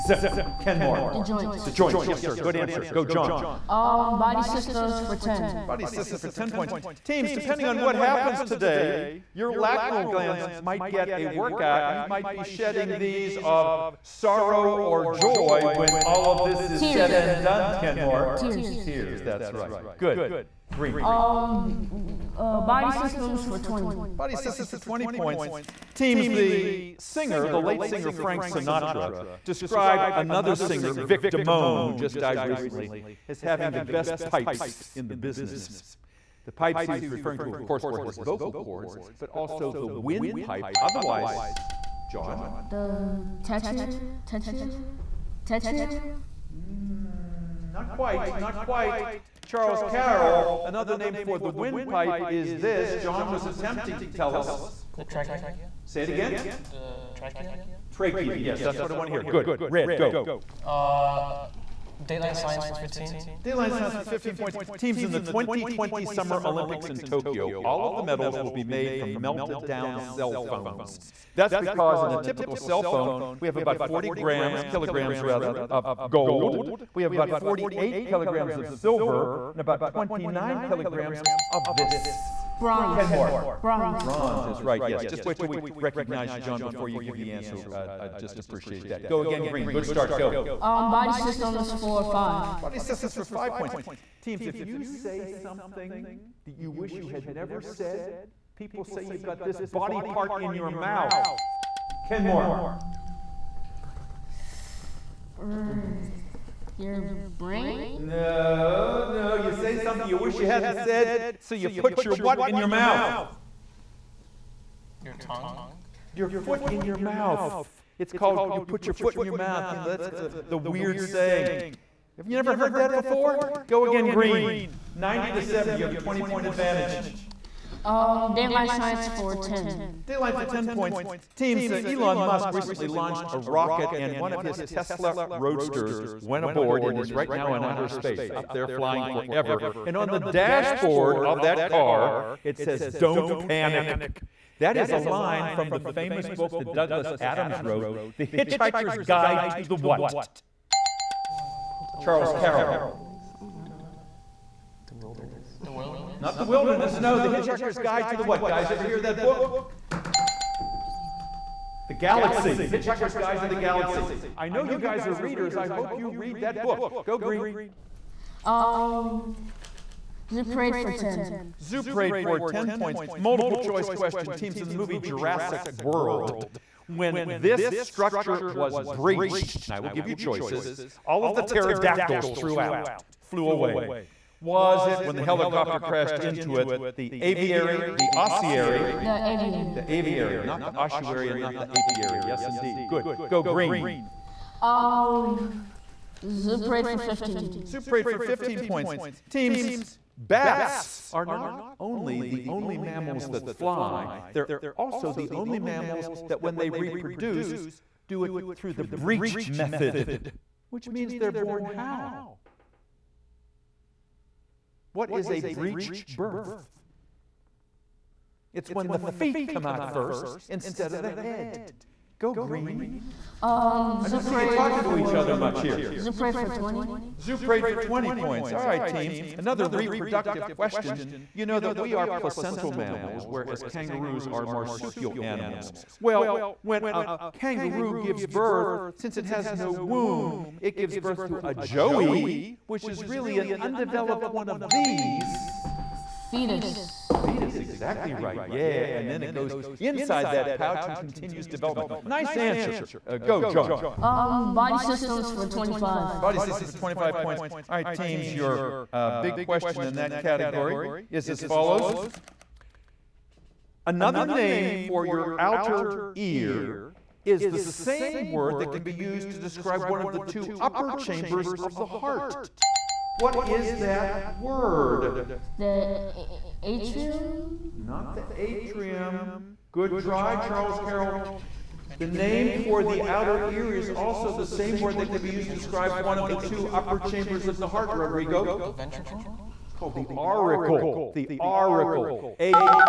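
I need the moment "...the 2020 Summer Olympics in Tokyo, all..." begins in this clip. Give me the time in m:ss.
1:05.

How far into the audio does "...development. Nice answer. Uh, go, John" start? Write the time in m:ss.
4:11.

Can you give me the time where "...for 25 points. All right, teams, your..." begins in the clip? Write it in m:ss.
4:16.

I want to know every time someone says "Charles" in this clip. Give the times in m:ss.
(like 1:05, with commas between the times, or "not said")
0:49, 2:31, 4:40.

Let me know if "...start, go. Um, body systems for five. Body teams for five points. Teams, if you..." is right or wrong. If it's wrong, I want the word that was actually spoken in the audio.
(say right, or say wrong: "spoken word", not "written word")
wrong: "systems", not "teams".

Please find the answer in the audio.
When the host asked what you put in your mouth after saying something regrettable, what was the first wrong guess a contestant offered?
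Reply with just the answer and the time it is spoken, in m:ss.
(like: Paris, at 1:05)
your brain, at 1:46.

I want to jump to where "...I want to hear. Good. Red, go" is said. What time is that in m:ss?
0:58.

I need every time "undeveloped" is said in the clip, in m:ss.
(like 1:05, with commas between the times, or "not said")
4:03.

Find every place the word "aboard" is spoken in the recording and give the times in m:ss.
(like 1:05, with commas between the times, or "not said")
2:16.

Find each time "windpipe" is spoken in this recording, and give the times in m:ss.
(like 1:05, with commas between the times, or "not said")
0:39, 0:51.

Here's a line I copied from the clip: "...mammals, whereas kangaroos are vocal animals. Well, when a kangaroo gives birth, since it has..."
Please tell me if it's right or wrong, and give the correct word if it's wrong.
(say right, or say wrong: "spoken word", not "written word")
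wrong: "marsupial", not "vocal".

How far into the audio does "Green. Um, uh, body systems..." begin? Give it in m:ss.
0:20.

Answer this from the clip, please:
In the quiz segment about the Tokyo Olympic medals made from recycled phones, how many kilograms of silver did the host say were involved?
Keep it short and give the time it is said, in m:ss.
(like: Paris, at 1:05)
48, at 1:17.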